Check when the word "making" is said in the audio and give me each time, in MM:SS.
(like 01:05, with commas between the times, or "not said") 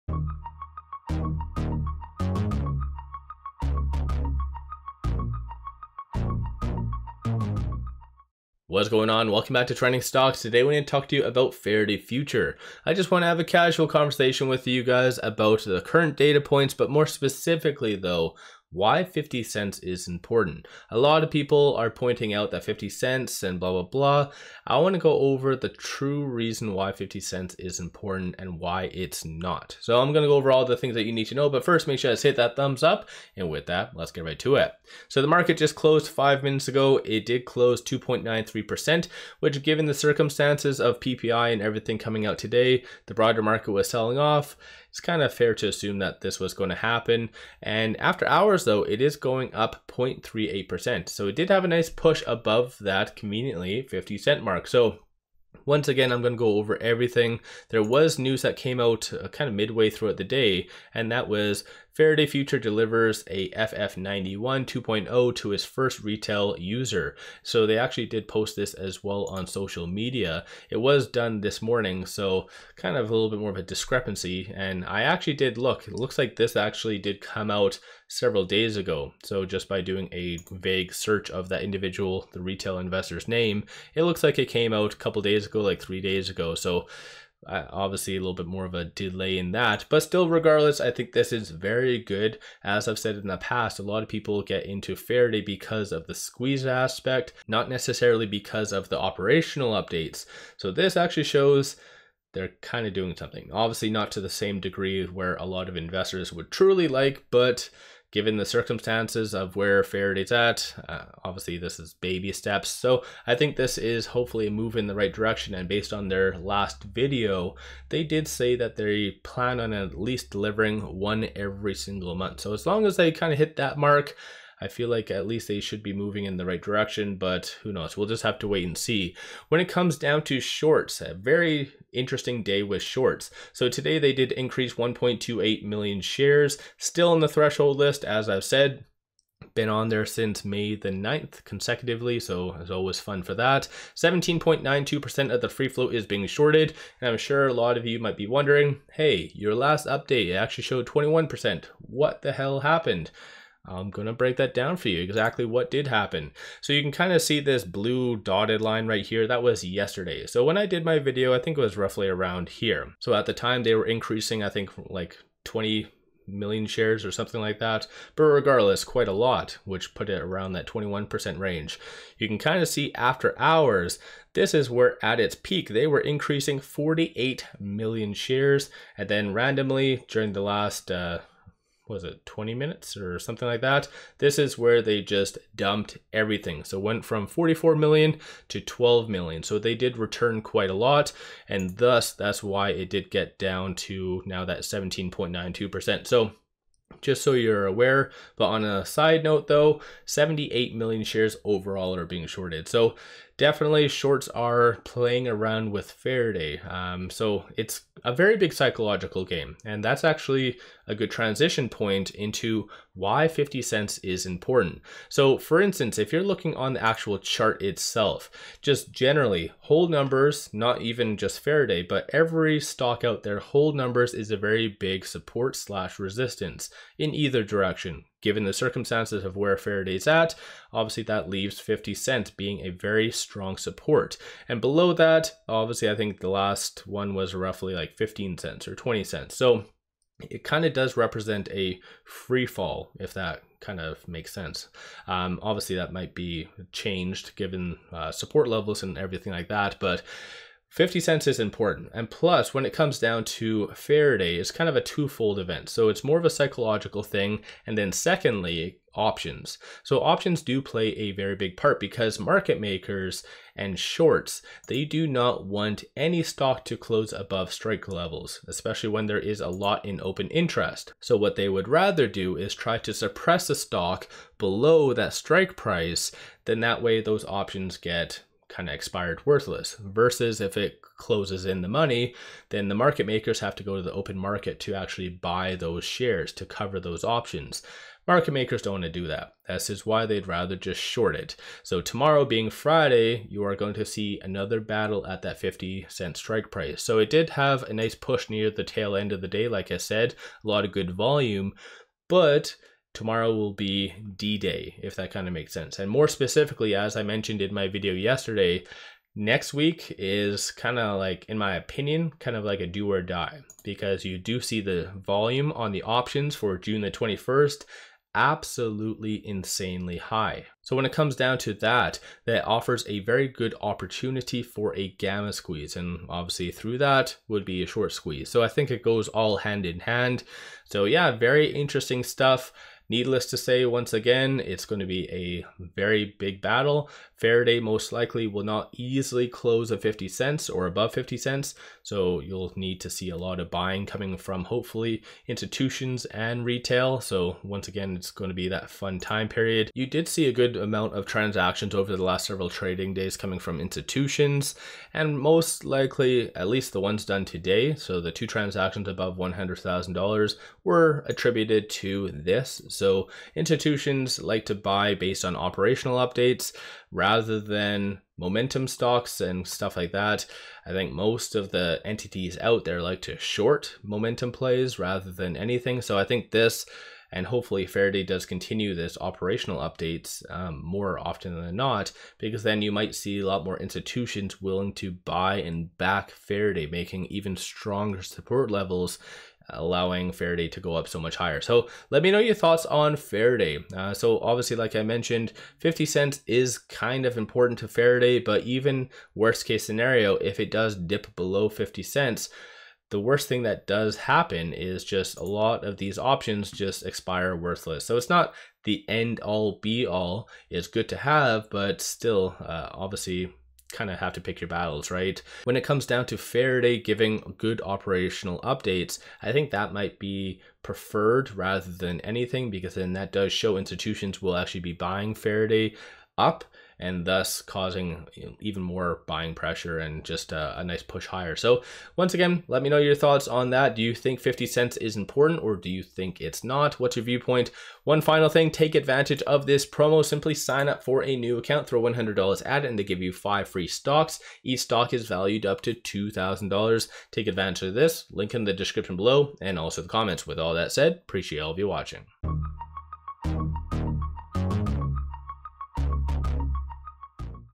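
06:26.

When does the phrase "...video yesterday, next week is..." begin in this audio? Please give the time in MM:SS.
05:07.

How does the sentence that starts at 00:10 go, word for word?
Today we're going to talk to you about Faraday Future.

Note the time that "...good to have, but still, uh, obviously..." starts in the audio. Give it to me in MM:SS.
06:50.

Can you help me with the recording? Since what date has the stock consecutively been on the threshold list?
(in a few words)
May 9.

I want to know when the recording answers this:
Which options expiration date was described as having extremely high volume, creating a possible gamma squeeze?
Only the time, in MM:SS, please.
05:16.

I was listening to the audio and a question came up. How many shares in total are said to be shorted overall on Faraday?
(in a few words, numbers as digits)
78 million.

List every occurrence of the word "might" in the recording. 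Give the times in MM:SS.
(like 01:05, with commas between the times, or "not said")
02:27, 04:05, 06:22, 06:59.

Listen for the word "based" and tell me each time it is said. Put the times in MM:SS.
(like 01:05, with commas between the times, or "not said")
01:55, 06:04.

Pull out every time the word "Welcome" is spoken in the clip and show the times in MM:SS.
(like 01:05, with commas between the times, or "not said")
00:09.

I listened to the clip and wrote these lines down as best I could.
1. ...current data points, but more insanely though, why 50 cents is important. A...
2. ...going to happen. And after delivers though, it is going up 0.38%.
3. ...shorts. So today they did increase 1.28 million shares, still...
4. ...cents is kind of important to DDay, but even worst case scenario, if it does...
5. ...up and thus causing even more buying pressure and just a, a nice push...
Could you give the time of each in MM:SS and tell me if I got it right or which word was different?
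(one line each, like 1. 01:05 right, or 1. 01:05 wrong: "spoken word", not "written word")
1. 00:15 wrong: "specifically", not "insanely"
2. 00:46 wrong: "hours", not "delivers"
3. 02:12 right
4. 06:35 wrong: "Faraday", not "DDay"
5. 07:06 right.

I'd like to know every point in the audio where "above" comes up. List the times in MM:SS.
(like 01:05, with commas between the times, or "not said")
00:52, 04:27, 05:40, 05:58.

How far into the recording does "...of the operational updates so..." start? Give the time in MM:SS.
01:38.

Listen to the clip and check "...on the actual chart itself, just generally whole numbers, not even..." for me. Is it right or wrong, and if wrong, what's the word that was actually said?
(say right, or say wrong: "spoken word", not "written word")
right.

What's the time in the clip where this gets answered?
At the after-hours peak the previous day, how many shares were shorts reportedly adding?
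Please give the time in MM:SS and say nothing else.
02:56.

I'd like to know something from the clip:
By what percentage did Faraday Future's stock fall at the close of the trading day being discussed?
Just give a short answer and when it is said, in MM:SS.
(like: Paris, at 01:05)
2.93%, at 00:37.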